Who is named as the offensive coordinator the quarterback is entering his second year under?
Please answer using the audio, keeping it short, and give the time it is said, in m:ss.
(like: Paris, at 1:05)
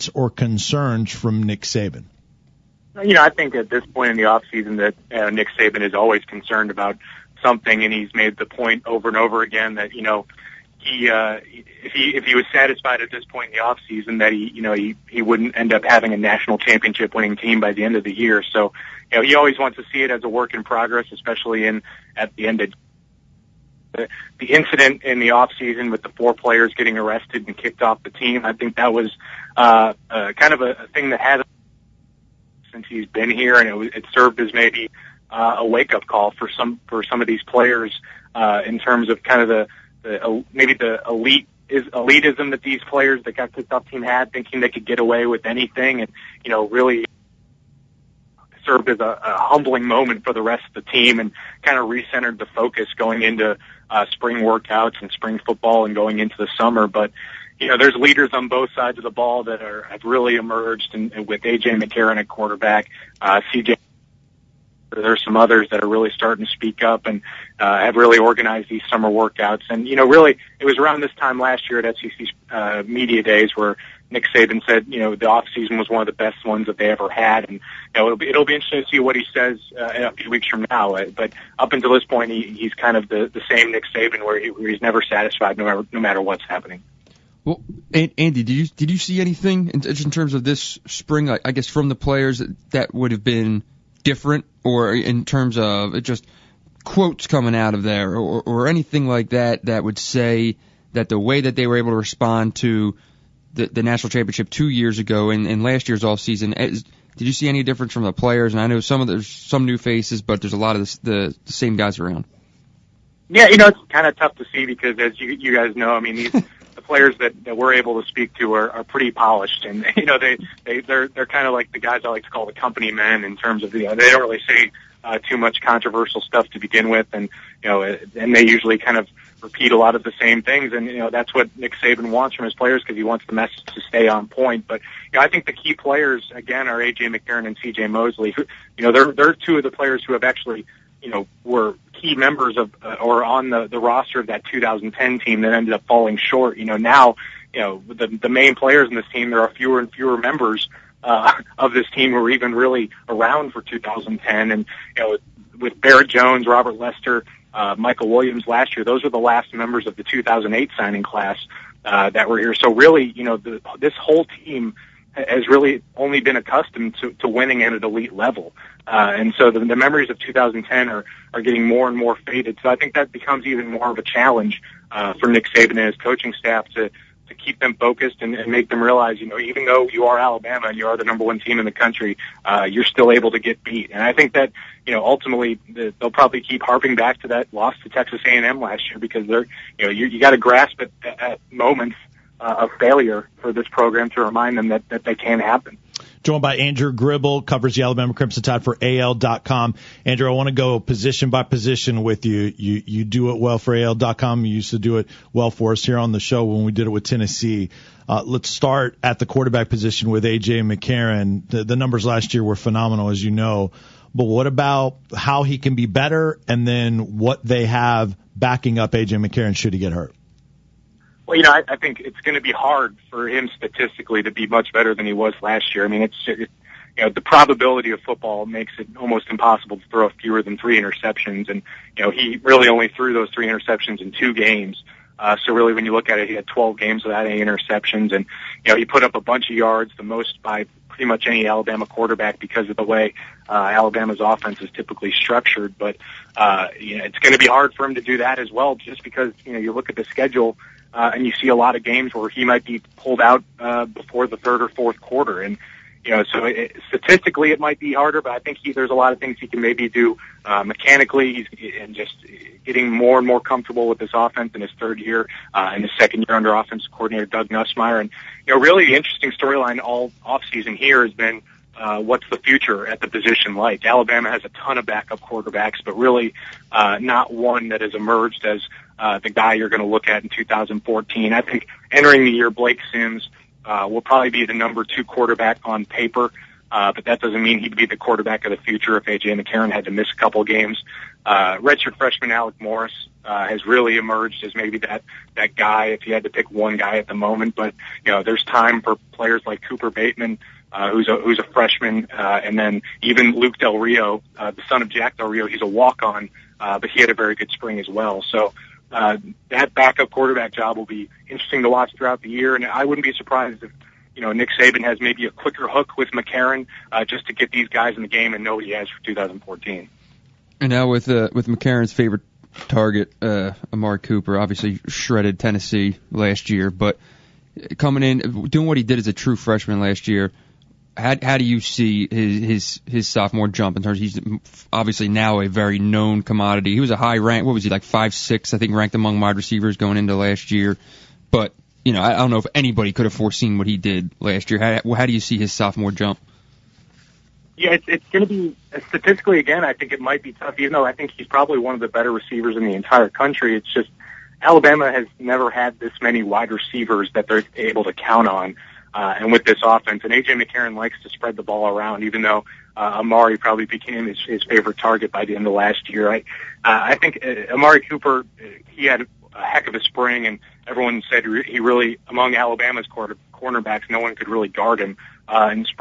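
Doug Nussmeier, at 4:27.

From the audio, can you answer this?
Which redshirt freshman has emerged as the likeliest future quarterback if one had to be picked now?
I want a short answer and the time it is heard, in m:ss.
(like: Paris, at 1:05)
Alec Morris, at 4:52.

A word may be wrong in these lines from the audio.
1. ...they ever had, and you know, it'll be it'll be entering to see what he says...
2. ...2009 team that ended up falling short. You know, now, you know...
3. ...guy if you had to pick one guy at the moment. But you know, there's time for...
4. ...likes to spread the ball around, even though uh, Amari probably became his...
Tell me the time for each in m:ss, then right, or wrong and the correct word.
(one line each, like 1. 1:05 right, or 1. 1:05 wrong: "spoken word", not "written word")
1. 1:16 wrong: "interesting", not "entering"
2. 2:24 wrong: "2010", not "2009"
3. 4:55 right
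4. 6:00 right.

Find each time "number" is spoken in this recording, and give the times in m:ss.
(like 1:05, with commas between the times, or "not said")
3:01, 3:31, 4:44.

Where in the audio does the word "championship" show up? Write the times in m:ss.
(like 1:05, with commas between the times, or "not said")
0:16, 1:44.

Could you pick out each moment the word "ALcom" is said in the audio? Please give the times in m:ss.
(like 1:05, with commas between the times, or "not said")
3:18, 3:23.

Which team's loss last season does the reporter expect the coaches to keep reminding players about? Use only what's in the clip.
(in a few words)
Texas A&M.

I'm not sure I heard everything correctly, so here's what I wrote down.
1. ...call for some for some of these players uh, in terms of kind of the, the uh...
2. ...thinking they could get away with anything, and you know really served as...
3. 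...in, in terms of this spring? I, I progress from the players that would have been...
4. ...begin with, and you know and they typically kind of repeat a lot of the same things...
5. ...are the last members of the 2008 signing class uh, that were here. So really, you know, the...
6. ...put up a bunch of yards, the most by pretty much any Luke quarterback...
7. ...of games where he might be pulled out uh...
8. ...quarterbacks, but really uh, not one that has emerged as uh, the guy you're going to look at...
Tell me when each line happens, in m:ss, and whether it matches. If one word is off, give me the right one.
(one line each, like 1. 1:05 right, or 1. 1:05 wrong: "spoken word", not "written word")
1. 0:36 right
2. 0:44 right
3. 1:29 wrong: "guess", not "progress"
4. 2:06 wrong: "usually", not "typically"
5. 2:39 right
6. 3:58 wrong: "Alabama", not "Luke"
7. 4:11 right
8. 4:35 right.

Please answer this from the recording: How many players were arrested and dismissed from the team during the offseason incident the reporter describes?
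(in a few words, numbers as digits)
4.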